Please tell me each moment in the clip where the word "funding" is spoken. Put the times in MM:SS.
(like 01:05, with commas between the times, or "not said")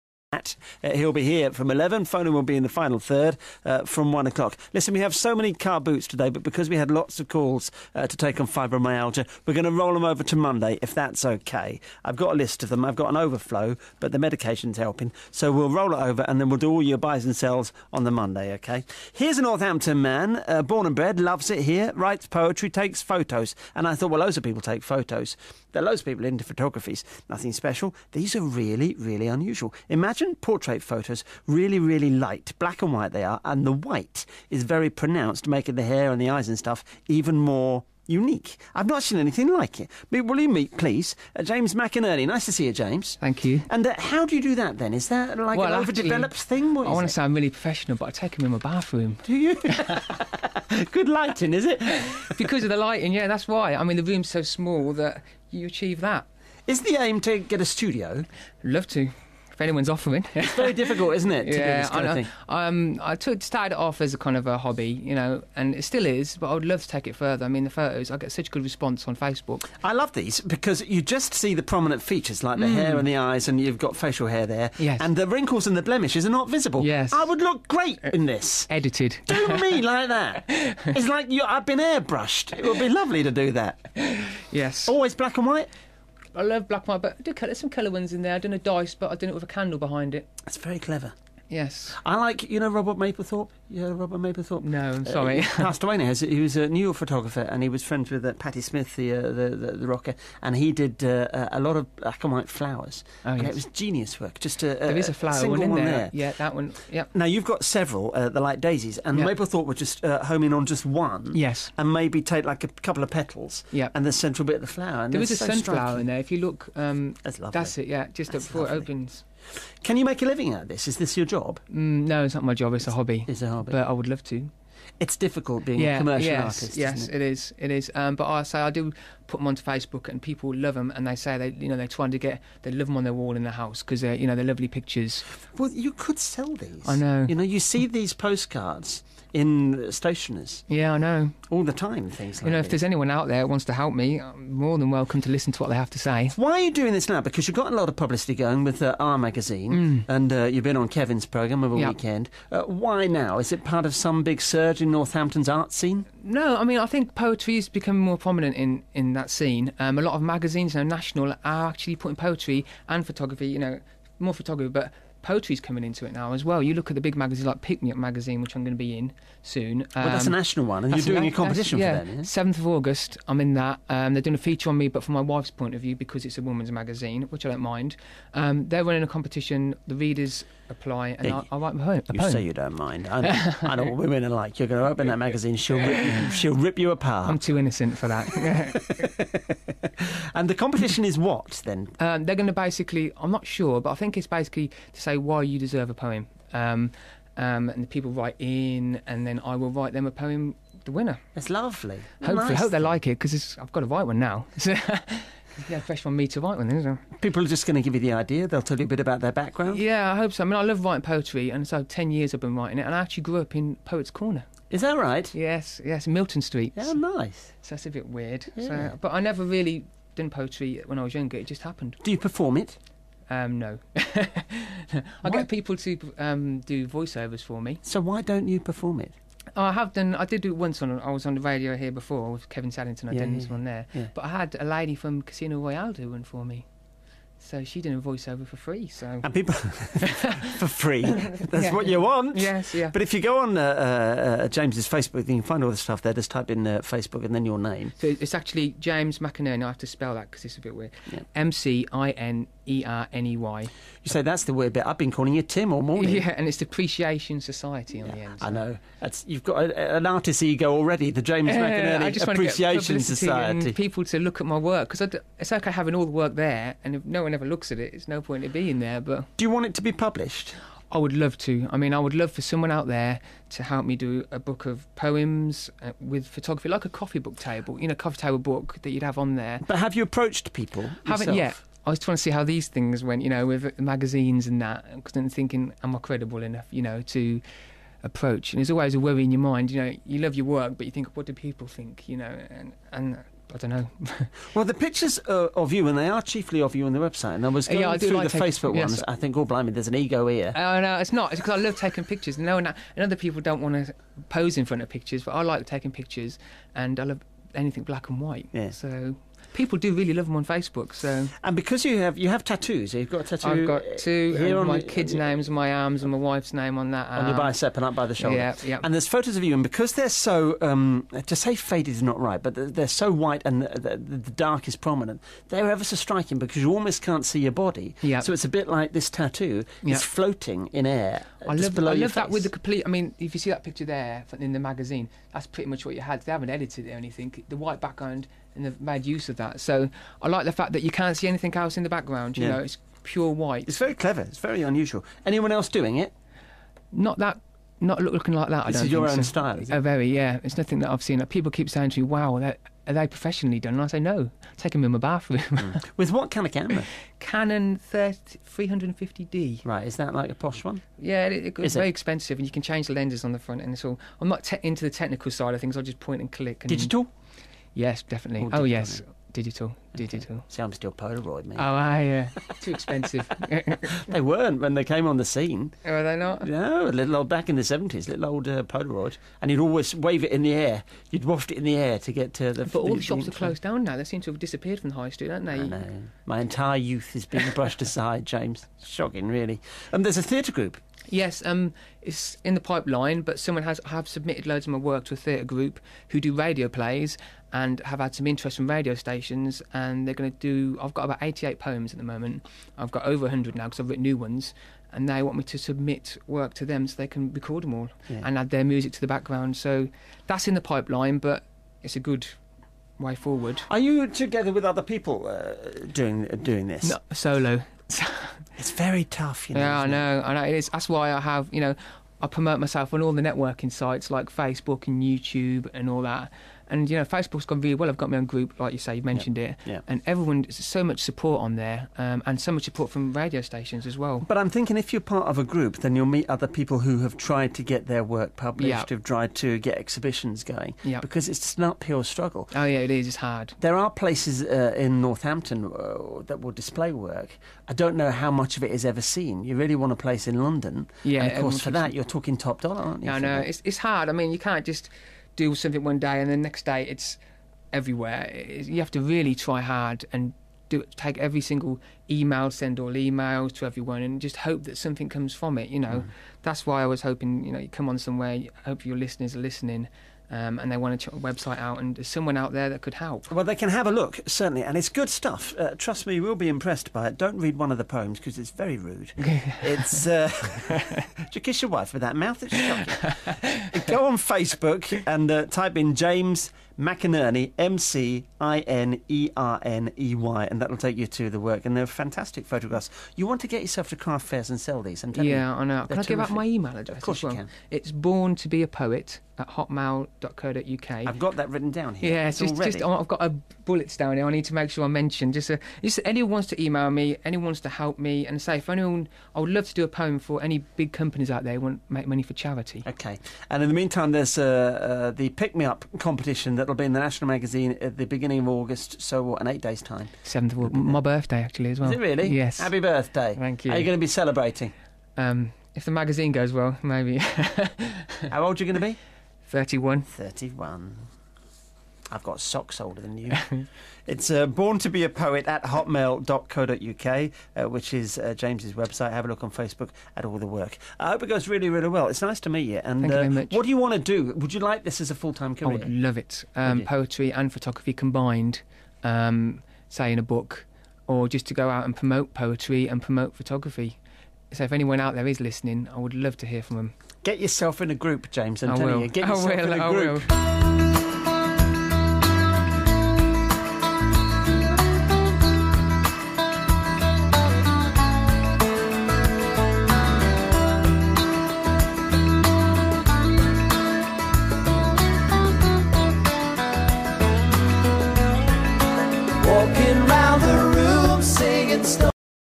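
not said.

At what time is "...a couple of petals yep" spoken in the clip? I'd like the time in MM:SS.
01:52.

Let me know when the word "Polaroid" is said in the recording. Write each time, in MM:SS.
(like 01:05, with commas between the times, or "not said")
06:10, 06:18.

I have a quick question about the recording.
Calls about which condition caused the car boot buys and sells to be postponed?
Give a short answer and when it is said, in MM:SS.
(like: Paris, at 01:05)
fibromyalgia, at 00:08.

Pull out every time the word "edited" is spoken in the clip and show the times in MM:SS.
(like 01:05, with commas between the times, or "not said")
01:18, 05:36.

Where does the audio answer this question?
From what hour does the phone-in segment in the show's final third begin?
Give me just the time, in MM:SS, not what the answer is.
00:04.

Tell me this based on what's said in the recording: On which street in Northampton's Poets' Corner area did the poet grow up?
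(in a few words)
Milton Street.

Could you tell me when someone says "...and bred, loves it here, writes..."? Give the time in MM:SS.
00:20.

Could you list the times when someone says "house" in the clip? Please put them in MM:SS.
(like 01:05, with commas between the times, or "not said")
02:13.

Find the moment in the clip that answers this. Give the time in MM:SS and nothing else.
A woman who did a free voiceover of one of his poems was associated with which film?
03:55.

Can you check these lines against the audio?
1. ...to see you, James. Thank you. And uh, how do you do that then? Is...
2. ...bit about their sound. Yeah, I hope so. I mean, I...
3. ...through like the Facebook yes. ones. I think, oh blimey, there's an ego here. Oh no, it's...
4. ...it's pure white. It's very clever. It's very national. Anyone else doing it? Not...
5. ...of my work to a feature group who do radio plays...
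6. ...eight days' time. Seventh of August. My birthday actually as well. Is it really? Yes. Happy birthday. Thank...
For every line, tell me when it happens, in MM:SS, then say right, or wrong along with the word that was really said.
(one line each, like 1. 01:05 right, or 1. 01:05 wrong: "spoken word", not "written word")
1. 00:42 right
2. 03:28 wrong: "background", not "sound"
3. 04:57 right
4. 05:42 wrong: "unusual", not "national"
5. 06:34 wrong: "theatre", not "feature"
6. 08:39 right.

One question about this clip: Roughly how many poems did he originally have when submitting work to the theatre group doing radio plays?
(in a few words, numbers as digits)
88.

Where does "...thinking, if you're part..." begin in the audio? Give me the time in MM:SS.
07:14.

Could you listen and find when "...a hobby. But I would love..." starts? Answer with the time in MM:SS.
02:03.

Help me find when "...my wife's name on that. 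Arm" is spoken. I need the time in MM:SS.
05:16.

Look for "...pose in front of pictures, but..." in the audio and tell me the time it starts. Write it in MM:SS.
05:04.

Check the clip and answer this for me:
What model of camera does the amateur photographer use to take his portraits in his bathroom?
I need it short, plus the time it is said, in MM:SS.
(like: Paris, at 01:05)
Canon 350D, at 05:57.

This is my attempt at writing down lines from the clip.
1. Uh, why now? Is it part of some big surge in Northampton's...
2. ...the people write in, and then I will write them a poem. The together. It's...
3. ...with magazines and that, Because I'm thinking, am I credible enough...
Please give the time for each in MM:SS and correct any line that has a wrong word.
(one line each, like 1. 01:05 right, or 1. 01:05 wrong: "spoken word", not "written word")
1. 02:32 right
2. 03:17 wrong: "winner", not "together"
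3. 04:43 right.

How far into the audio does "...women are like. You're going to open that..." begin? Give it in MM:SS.
03:03.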